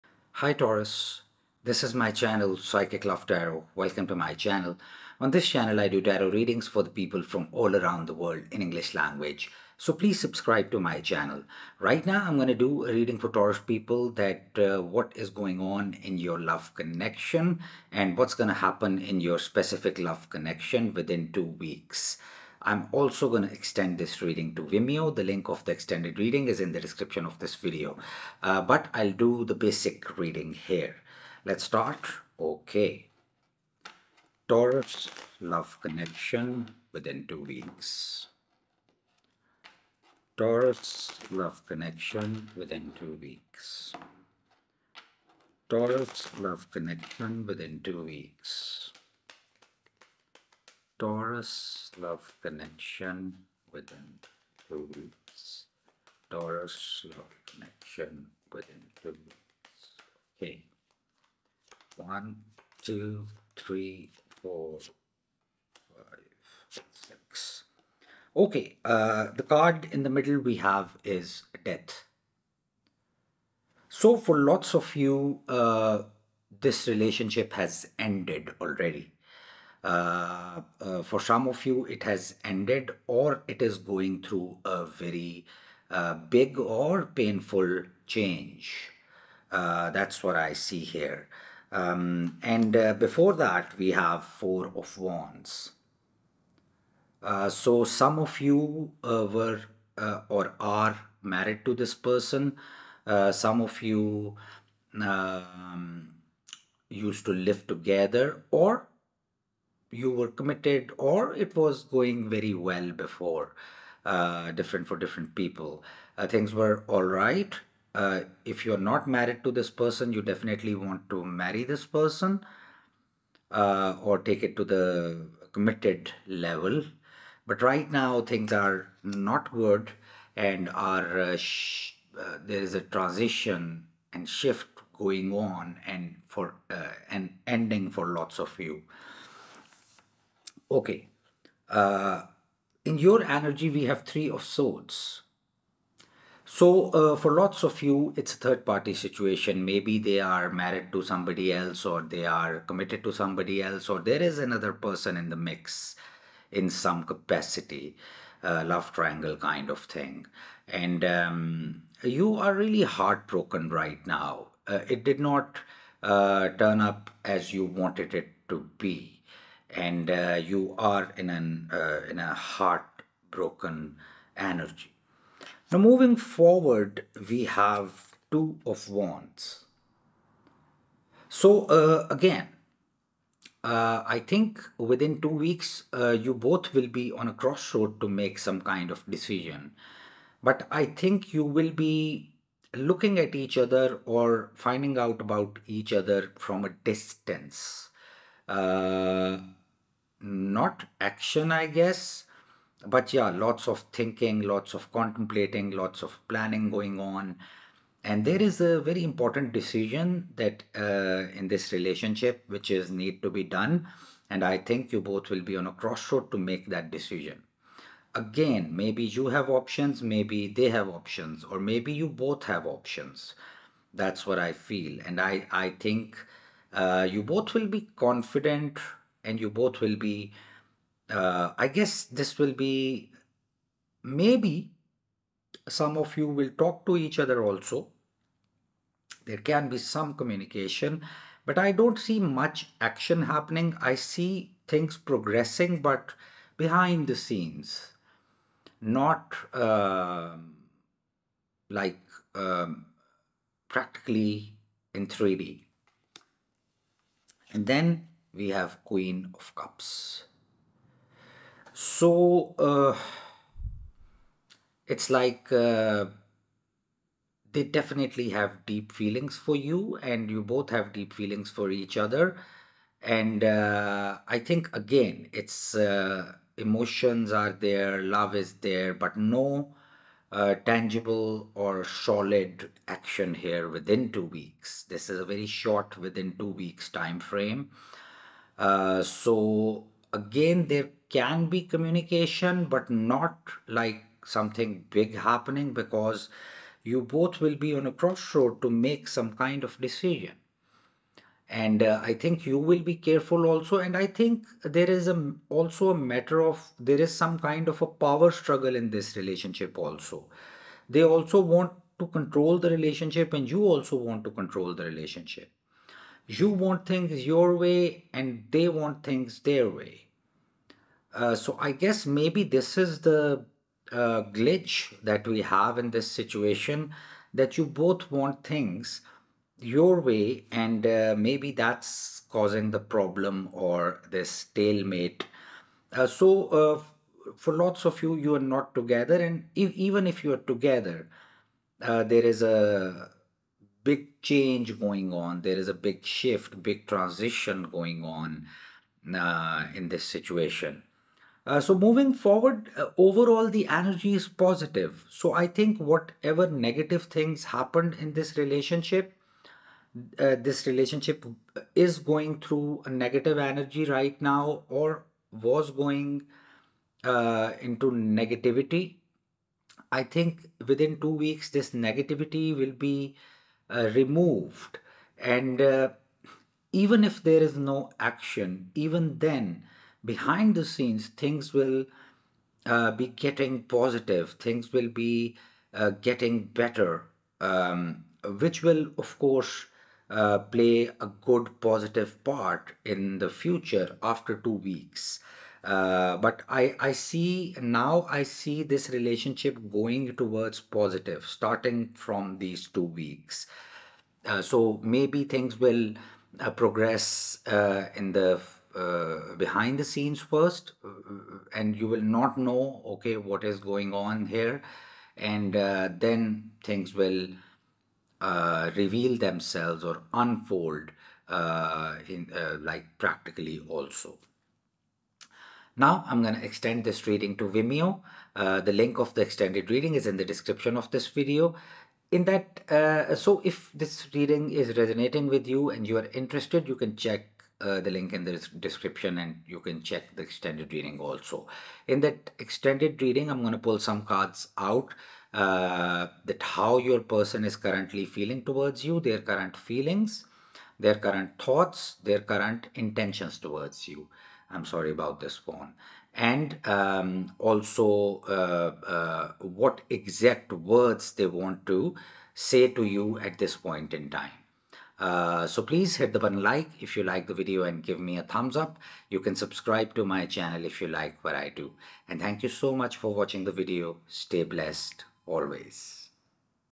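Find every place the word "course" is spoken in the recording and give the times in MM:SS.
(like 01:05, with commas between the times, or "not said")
06:29.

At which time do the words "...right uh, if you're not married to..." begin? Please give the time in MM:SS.
01:57.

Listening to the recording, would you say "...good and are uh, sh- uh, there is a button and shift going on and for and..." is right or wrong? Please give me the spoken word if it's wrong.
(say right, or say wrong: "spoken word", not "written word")
wrong: "transition", not "button".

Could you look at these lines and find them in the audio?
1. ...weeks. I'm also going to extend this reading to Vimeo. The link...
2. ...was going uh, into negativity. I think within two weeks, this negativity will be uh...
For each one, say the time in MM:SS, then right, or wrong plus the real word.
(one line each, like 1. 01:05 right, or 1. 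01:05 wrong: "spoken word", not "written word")
1. 00:21 right
2. 06:05 right.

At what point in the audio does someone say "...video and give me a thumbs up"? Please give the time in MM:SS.
07:47.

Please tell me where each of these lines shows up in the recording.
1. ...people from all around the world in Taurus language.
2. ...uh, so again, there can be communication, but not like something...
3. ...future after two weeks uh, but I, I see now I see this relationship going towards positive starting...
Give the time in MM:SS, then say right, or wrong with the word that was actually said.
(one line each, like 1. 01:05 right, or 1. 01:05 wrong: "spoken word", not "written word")
1. 00:06 wrong: "English", not "Taurus"
2. 04:48 right
3. 06:33 right.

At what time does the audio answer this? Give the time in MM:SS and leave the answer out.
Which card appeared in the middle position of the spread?
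01:11.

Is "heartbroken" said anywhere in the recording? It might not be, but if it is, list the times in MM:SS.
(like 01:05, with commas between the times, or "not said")
02:42, 02:52.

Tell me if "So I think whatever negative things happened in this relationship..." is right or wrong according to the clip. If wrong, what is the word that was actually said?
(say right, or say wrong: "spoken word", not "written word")
right.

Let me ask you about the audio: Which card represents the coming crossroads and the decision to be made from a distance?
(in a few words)
Two of Wands.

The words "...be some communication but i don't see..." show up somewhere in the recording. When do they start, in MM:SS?
03:59.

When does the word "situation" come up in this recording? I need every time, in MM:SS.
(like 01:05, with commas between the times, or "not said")
02:28, 05:26, 05:50.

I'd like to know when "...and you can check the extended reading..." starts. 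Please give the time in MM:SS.
07:19.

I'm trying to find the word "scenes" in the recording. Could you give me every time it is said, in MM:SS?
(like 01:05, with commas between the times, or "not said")
04:07, 06:20, 06:49.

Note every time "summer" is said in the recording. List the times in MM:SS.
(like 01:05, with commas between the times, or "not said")
not said.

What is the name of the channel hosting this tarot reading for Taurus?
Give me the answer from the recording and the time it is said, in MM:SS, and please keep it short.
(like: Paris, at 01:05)
Psychic Love Tarot, at 00:02.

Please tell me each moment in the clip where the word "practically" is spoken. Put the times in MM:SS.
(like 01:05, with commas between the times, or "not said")
04:13, 07:02.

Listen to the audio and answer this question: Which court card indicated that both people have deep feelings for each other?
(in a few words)
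Queen of Cups.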